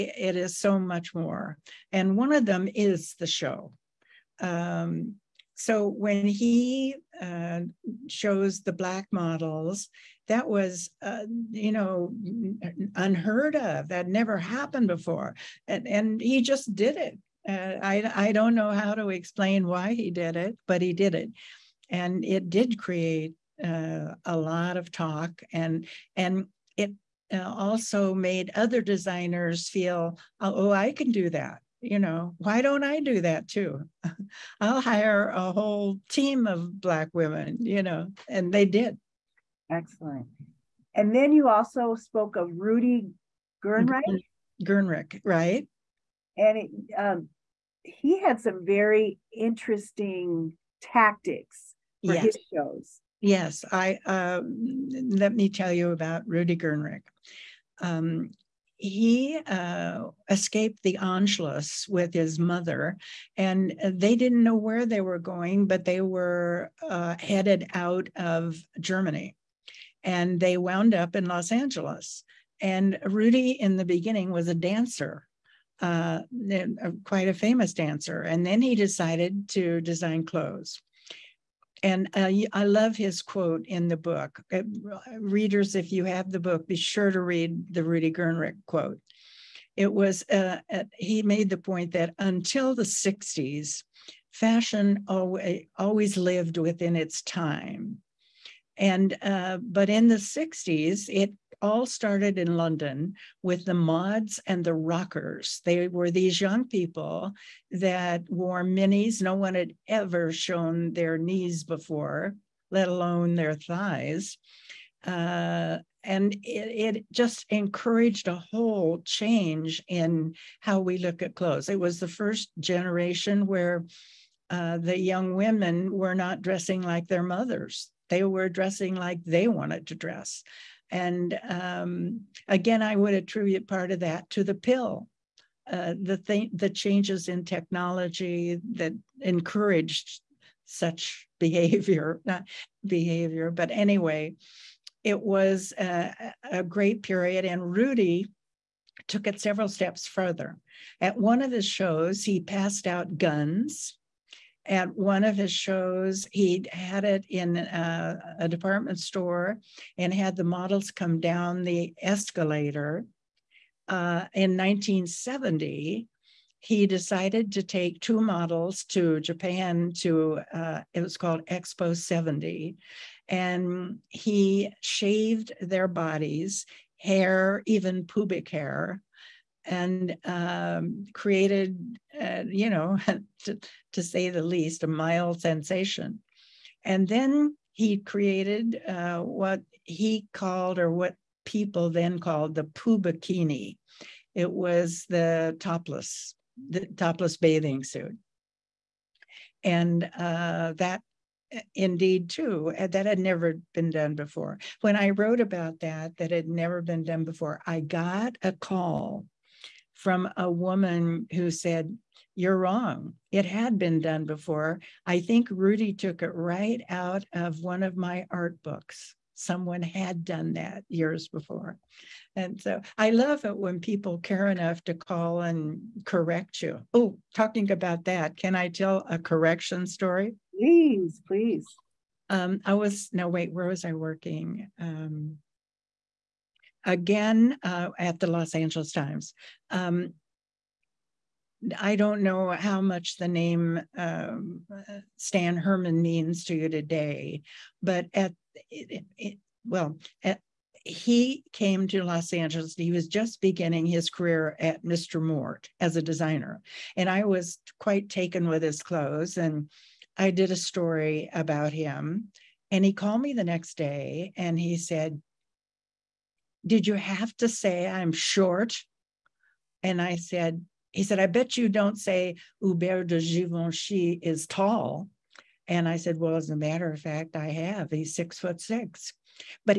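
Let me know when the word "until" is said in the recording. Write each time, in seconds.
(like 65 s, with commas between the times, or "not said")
92 s.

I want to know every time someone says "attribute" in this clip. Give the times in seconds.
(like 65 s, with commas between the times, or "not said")
133 s.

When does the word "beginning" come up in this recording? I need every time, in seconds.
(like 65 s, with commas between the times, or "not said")
73 s, 253 s.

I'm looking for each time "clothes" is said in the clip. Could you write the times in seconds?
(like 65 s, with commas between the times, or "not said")
80 s, 121 s, 258 s.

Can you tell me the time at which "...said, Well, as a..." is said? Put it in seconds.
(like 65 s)
275 s.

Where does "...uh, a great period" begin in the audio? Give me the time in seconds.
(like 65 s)
146 s.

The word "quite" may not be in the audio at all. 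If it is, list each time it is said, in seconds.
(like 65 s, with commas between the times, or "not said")
77 s, 257 s.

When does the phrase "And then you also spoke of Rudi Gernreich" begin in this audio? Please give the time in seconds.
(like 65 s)
40 s.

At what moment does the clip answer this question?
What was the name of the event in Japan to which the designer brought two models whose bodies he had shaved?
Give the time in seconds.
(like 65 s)
171 s.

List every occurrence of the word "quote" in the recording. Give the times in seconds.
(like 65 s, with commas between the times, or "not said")
83 s, 88 s.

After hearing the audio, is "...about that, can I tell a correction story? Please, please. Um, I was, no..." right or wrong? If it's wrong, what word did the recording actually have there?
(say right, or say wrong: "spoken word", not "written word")
right.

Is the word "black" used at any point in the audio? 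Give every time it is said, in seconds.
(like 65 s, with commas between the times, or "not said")
8 s, 36 s.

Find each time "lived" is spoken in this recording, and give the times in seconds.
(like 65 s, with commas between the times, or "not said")
96 s.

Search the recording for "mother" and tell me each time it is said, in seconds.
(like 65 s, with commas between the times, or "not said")
62 s, 127 s.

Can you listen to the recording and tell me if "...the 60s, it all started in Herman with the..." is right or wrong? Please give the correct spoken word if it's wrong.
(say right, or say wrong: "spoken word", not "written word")
wrong: "London", not "Herman".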